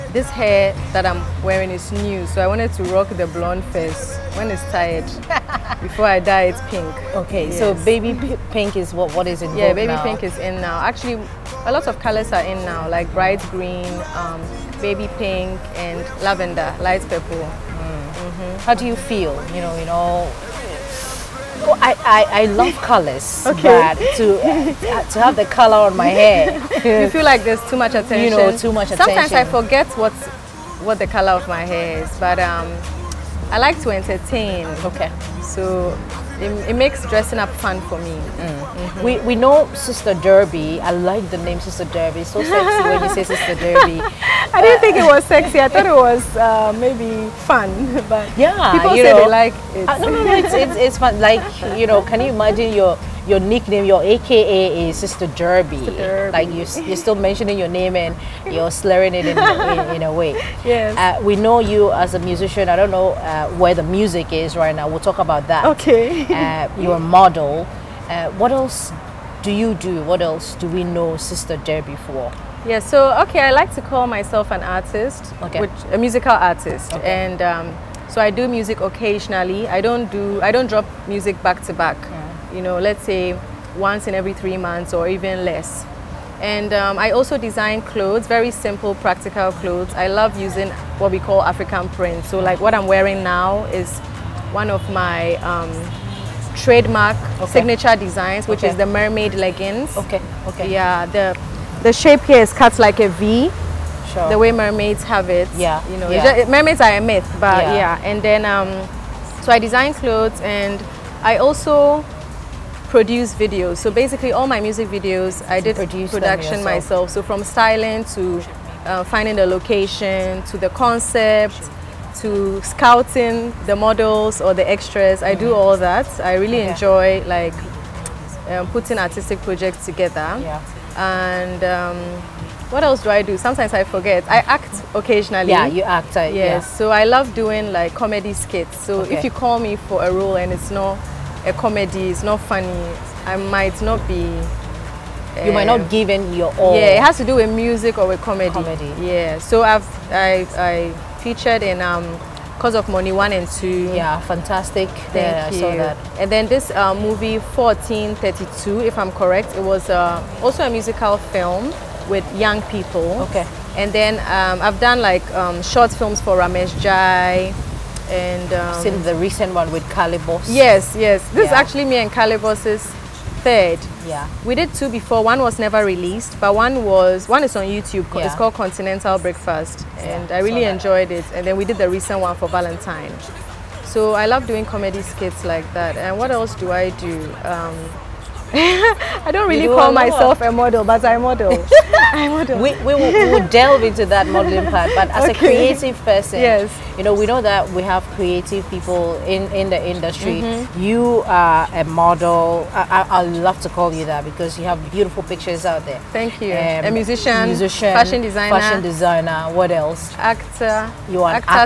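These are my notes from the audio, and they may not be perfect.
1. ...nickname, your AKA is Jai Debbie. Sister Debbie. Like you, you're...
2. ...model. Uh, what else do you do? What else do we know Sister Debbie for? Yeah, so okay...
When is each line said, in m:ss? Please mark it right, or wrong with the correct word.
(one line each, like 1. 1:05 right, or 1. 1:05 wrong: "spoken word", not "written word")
1. 0:53 wrong: "Sister", not "Jai"
2. 1:06 right.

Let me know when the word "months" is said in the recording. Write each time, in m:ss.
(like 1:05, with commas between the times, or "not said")
1:24.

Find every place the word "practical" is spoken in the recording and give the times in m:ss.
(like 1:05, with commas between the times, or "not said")
1:28.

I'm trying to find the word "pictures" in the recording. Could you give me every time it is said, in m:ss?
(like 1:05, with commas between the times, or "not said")
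3:25.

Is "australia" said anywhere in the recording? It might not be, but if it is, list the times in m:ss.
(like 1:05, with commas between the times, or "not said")
not said.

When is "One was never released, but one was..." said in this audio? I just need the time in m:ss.
2:55.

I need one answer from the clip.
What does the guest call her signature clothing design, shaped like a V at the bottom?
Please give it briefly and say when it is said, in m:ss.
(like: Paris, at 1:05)
mermaid leggings, at 1:38.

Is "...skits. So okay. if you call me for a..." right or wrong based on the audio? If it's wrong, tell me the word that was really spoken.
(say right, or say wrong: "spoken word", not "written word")
right.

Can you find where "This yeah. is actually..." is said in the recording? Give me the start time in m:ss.
2:51.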